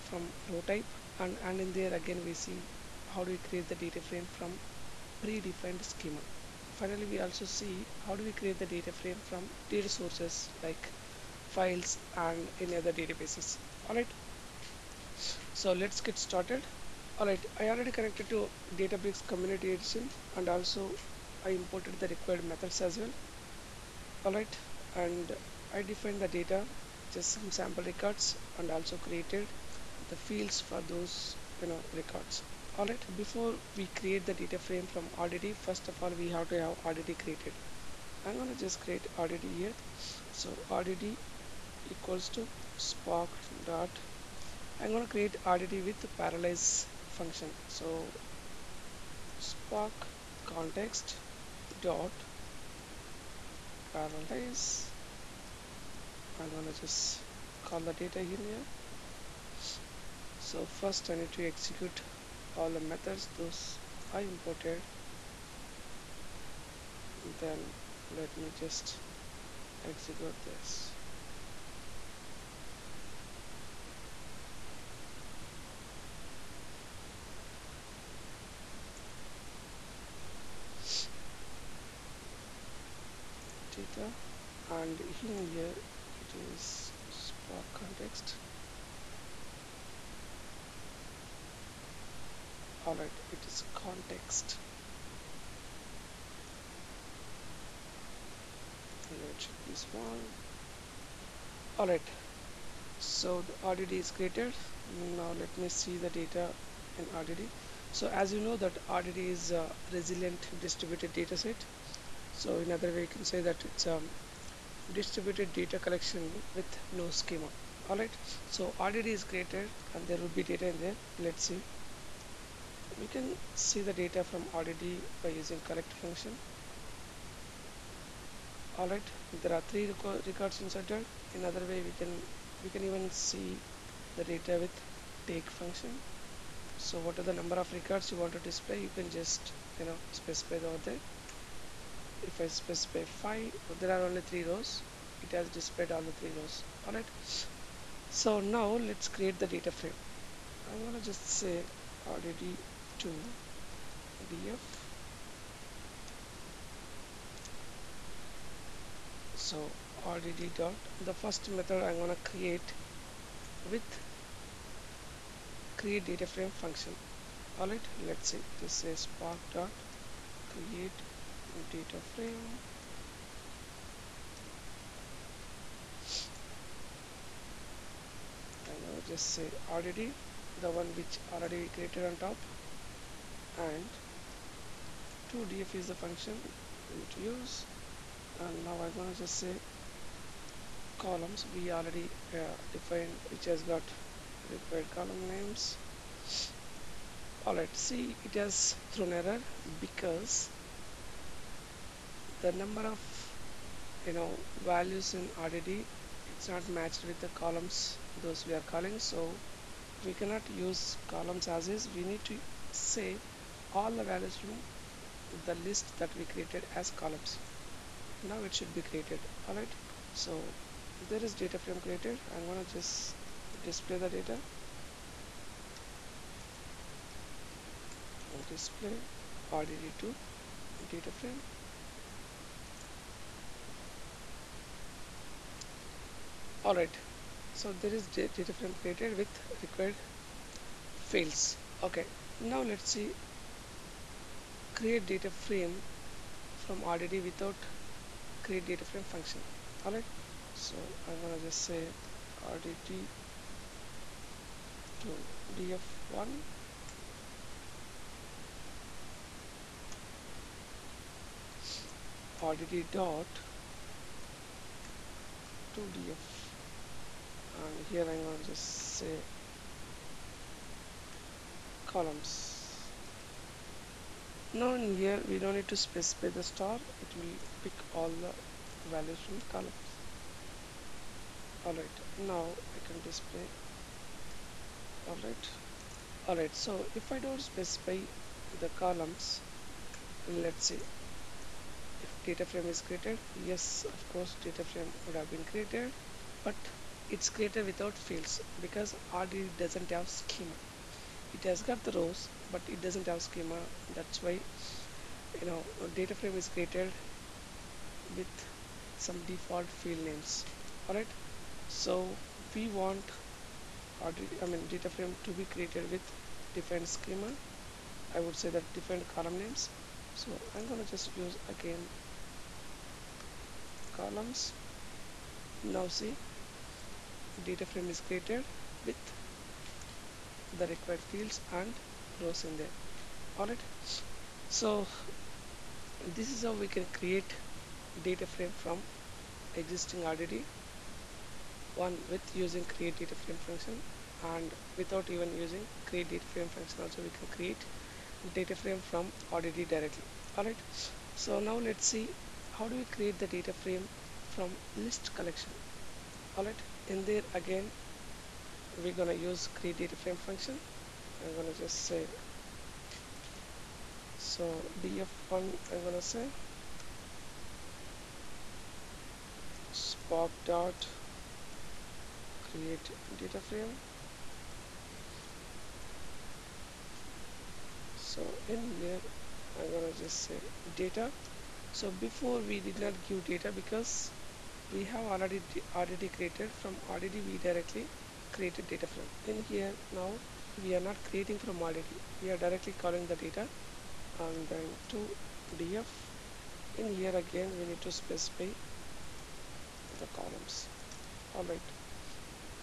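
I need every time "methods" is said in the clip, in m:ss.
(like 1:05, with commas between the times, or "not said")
0:22, 1:02, 2:41.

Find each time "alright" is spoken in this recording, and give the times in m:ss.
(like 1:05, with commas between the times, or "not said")
3:17.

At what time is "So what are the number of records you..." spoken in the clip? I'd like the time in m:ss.
2:16.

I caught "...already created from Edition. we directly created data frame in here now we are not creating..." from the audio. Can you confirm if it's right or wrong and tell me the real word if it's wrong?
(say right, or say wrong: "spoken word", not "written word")
wrong: "RDD", not "Edition".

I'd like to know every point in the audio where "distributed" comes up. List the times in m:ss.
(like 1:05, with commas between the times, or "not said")
1:50, 1:54.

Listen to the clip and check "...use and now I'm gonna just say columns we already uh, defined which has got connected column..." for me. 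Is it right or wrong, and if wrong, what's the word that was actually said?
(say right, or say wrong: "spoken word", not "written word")
wrong: "required", not "connected".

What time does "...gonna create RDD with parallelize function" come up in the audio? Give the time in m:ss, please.
0:44.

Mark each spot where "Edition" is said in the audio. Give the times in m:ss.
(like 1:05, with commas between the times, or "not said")
0:19.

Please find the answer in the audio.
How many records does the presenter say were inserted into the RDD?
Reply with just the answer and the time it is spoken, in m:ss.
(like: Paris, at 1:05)
3, at 2:09.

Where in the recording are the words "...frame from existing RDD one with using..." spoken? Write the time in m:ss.
5:38.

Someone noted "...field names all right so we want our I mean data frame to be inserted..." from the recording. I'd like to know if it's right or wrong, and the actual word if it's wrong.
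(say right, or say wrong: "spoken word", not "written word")
wrong: "created", not "inserted".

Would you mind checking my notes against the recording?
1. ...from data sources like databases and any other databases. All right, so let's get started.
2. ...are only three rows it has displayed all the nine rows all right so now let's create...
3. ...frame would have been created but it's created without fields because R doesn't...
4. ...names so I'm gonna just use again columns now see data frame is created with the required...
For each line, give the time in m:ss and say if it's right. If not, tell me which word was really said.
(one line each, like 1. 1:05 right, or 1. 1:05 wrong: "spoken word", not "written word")
1. 0:09 wrong: "files", not "databases"
2. 2:23 wrong: "three", not "nine"
3. 4:54 right
4. 5:19 right.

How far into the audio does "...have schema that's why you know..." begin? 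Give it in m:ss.
5:03.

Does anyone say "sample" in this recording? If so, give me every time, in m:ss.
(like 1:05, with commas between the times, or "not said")
0:27.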